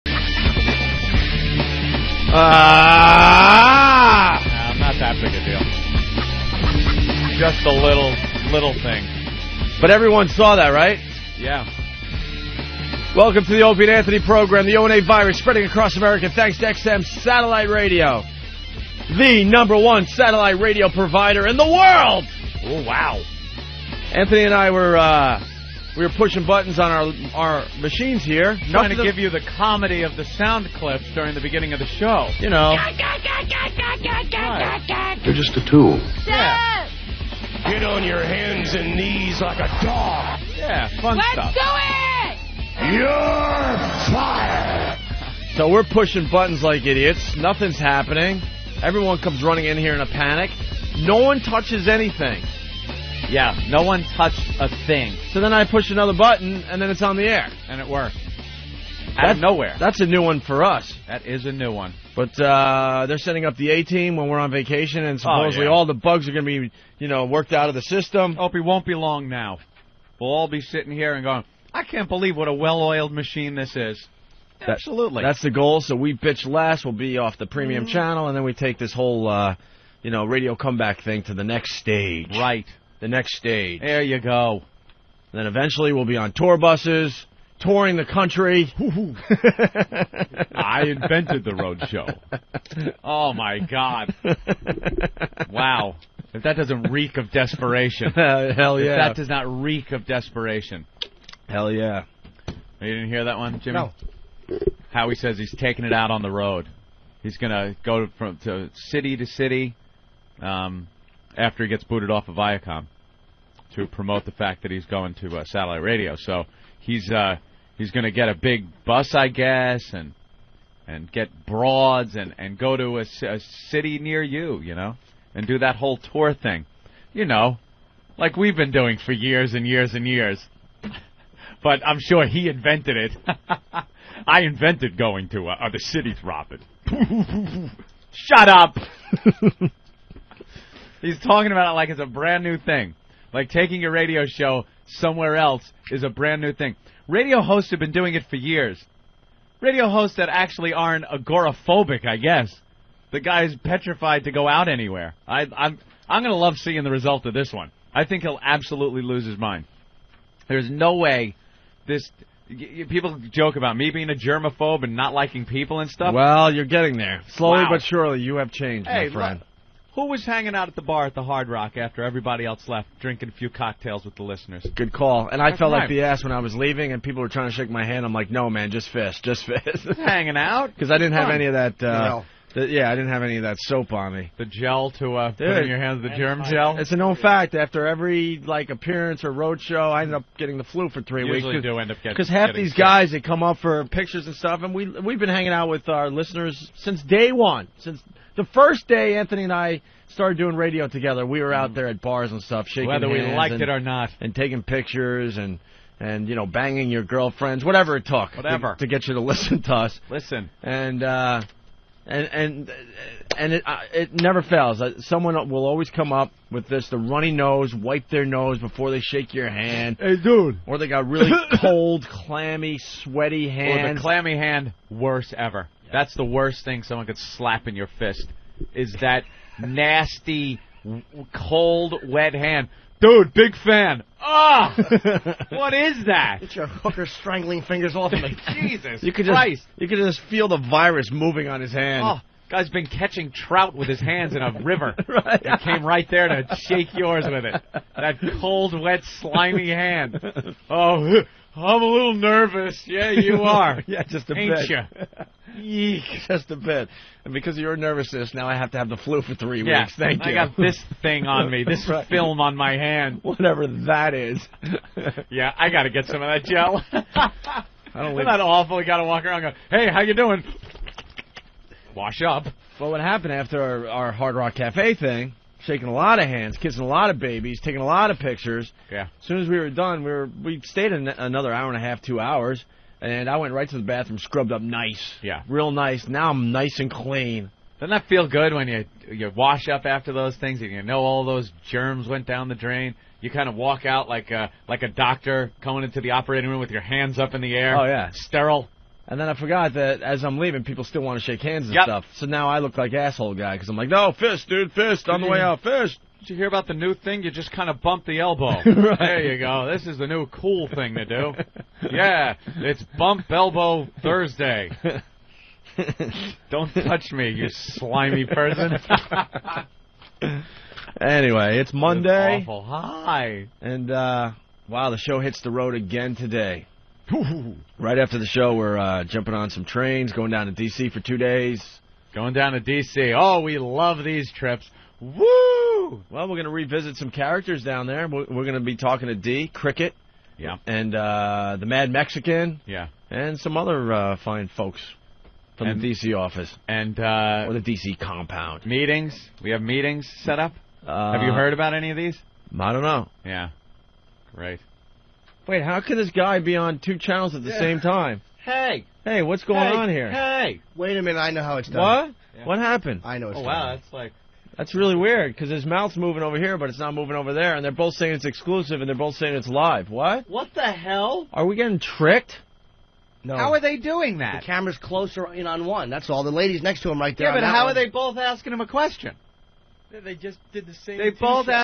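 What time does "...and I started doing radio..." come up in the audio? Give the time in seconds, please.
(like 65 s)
199 s.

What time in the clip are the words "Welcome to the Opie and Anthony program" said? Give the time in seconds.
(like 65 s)
13 s.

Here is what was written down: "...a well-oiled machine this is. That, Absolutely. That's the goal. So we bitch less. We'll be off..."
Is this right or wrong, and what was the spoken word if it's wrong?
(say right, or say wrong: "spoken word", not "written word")
right.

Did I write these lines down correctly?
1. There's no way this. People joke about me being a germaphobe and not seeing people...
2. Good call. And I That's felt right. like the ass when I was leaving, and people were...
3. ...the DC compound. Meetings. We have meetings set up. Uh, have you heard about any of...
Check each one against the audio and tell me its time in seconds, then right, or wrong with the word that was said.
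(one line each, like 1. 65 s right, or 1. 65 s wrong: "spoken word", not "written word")
1. 160 s wrong: "liking", not "seeing"
2. 174 s right
3. 347 s right.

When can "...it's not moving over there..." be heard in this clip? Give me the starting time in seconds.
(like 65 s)
366 s.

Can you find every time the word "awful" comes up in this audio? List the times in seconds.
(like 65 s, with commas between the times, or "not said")
268 s, 322 s.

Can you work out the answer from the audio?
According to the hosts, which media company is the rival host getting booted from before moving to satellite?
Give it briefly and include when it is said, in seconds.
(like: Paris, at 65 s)
Viacom, at 112 s.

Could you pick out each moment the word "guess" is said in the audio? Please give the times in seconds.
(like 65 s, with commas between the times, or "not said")
119 s, 152 s.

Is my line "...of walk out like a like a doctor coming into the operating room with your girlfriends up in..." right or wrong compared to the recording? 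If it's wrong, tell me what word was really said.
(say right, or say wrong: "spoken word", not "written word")
wrong: "hands", not "girlfriends".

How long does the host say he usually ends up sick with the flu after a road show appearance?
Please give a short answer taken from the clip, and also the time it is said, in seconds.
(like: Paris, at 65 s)
3 weeks, at 191 s.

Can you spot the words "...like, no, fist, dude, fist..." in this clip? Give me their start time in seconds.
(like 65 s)
303 s.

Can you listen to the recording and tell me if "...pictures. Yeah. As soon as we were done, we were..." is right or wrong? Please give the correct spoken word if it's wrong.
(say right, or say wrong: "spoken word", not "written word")
right.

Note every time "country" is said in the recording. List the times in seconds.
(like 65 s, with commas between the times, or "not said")
88 s.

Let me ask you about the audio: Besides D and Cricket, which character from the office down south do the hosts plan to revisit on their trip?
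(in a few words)
the Mad Mexican.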